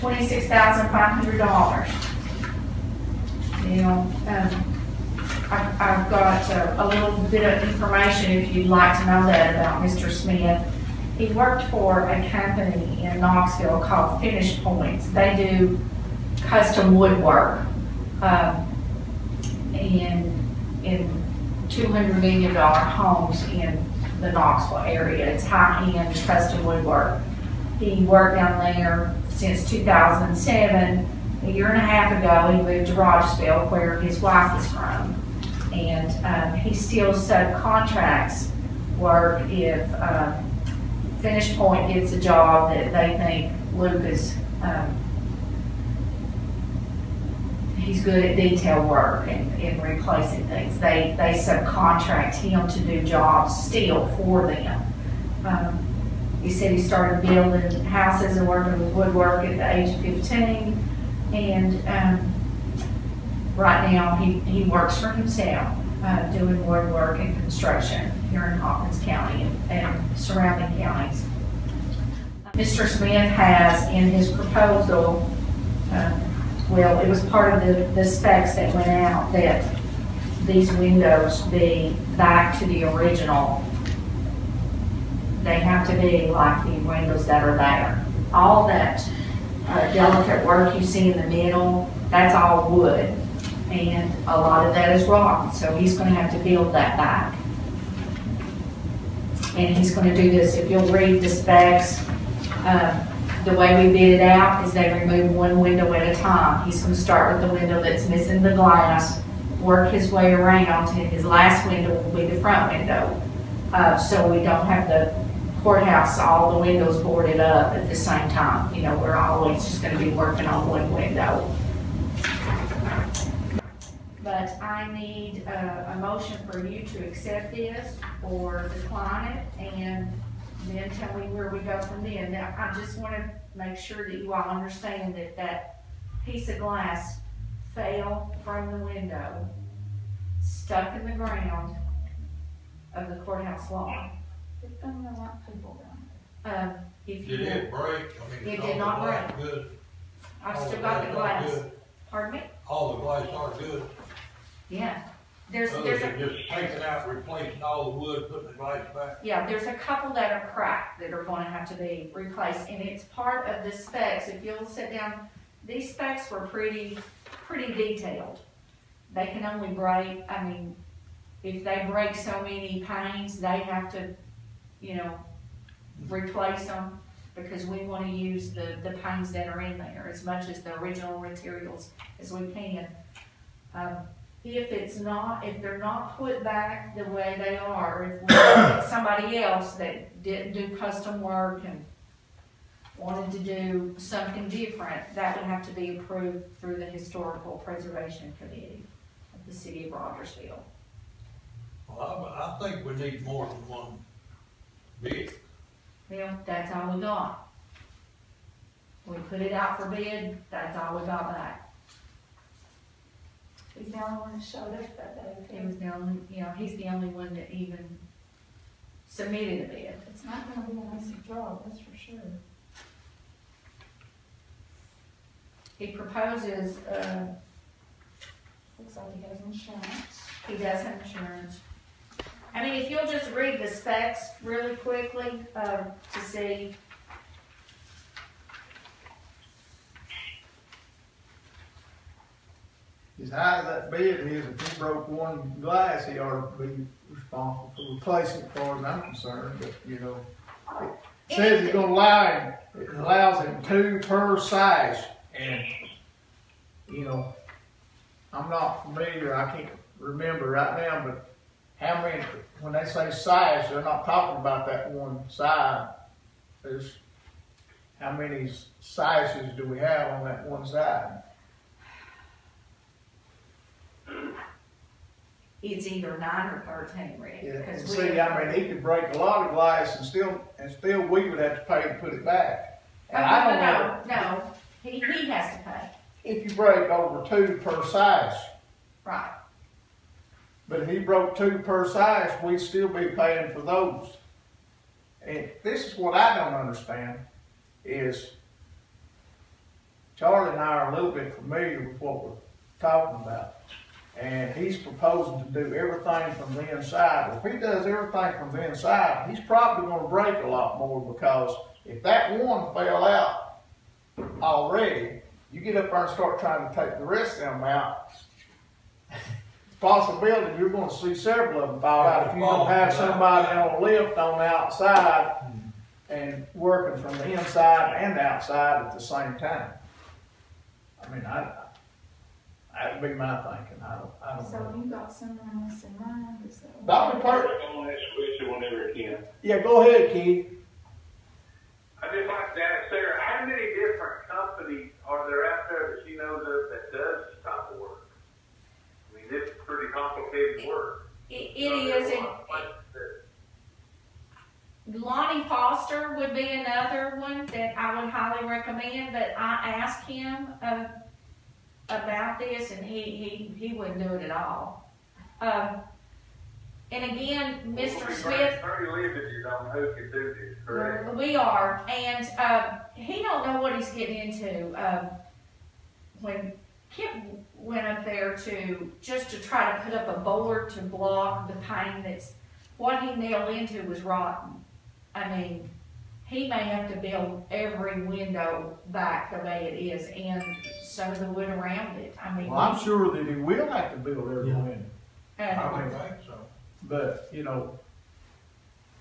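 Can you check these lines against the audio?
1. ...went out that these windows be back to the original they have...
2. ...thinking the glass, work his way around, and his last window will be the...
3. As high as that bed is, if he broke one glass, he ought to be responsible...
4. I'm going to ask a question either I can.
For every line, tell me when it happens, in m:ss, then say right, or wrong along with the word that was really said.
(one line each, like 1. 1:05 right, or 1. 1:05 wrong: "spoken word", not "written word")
1. 1:18 right
2. 1:48 wrong: "missing", not "thinking"
3. 4:03 right
4. 5:37 wrong: "whenever", not "either".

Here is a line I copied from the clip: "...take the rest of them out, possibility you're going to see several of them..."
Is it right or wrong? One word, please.
right.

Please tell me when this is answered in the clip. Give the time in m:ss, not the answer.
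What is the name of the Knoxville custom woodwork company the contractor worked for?
0:14.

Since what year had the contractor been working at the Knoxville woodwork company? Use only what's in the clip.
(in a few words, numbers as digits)
2007.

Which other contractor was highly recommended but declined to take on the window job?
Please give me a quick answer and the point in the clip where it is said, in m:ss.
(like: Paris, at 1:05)
Lonnie Foster, at 5:54.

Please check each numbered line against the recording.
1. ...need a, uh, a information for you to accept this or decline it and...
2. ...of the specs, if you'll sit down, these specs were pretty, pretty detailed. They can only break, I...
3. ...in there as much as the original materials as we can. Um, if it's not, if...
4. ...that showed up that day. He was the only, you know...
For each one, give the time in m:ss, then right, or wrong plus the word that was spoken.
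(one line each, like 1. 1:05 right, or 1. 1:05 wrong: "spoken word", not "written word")
1. 2:04 wrong: "motion", not "information"
2. 2:43 right
3. 2:59 right
4. 3:34 right.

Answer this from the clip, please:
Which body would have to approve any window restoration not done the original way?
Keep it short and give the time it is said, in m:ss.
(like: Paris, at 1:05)
Historical Preservation Committee, at 3:16.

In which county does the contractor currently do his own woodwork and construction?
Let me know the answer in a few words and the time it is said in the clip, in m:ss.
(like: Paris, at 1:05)
Hawkins County, at 1:08.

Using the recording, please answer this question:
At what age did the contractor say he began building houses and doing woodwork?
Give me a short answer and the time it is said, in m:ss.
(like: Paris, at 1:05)
15, at 1:00.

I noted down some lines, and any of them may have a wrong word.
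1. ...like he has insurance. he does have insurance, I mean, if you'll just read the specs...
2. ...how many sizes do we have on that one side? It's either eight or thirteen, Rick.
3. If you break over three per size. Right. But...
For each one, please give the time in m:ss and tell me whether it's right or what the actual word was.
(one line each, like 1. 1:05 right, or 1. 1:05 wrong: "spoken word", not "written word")
1. 3:48 right
2. 4:27 wrong: "nine", not "eight"
3. 4:46 wrong: "two", not "three".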